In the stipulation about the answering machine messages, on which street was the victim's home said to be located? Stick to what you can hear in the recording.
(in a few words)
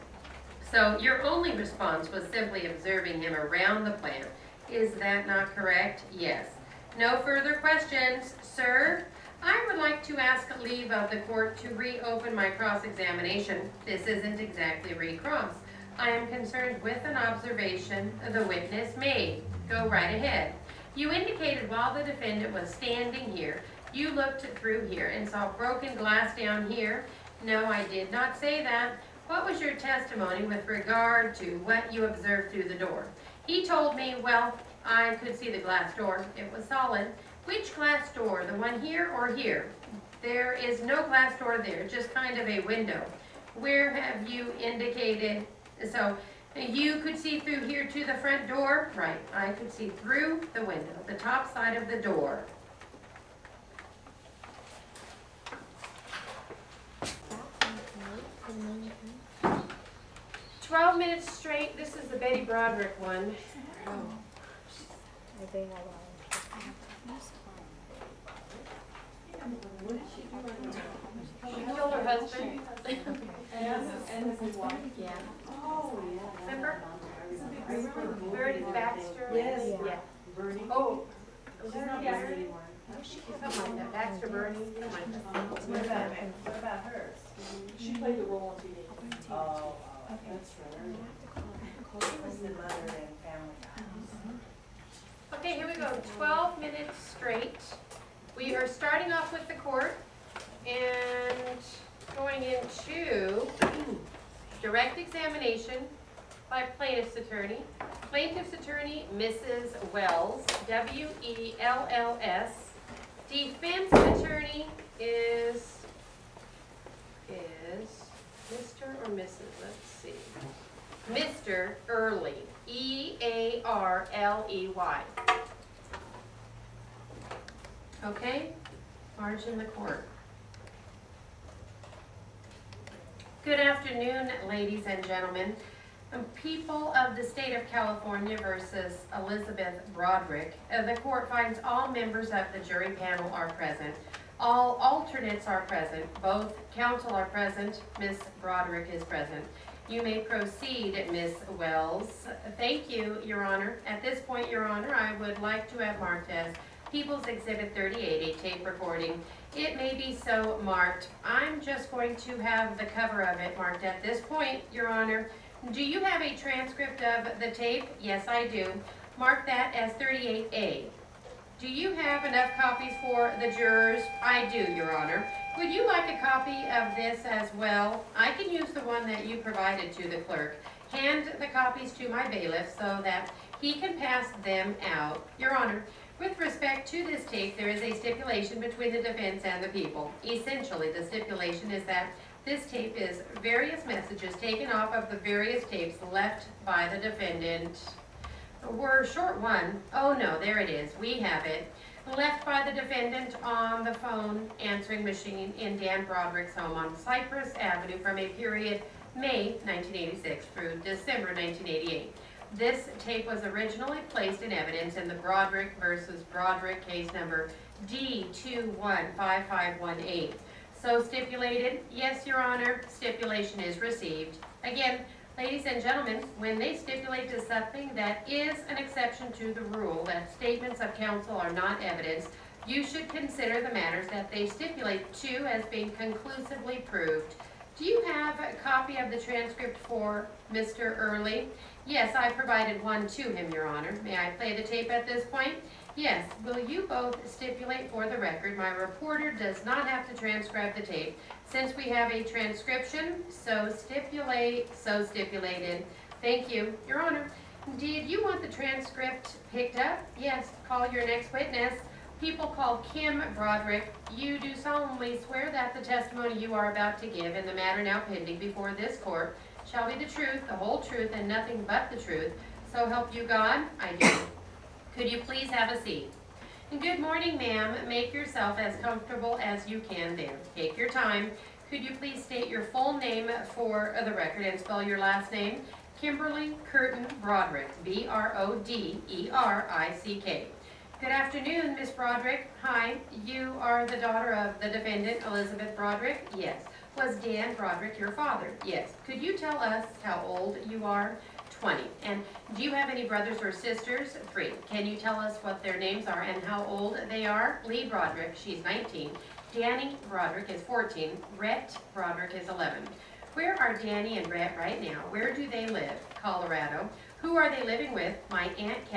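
Cypress Avenue.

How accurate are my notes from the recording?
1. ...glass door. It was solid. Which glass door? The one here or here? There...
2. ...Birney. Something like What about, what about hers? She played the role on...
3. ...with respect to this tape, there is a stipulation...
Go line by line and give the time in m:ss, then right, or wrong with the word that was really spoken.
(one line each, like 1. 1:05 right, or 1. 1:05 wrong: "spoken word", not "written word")
1. 0:35 right
2. 1:24 right
3. 3:06 right.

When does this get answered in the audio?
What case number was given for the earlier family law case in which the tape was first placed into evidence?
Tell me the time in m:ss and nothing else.
3:37.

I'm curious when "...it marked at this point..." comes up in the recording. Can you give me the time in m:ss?
2:43.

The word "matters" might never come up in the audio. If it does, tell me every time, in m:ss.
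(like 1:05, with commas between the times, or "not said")
3:53, 4:27.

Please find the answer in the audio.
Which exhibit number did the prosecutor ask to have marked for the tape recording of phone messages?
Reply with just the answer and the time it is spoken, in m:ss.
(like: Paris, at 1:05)
People's Exhibit 38, at 2:36.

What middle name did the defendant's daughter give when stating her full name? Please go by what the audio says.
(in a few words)
Curtin.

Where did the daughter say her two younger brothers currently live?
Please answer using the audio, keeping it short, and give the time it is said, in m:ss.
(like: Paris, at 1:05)
Colorado, at 5:16.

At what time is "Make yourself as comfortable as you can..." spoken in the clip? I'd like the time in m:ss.
4:37.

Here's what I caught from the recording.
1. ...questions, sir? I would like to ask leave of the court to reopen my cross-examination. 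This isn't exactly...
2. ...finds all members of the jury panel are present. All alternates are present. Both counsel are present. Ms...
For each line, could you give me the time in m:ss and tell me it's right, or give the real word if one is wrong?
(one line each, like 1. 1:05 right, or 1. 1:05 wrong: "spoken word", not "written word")
1. 0:07 right
2. 2:21 right.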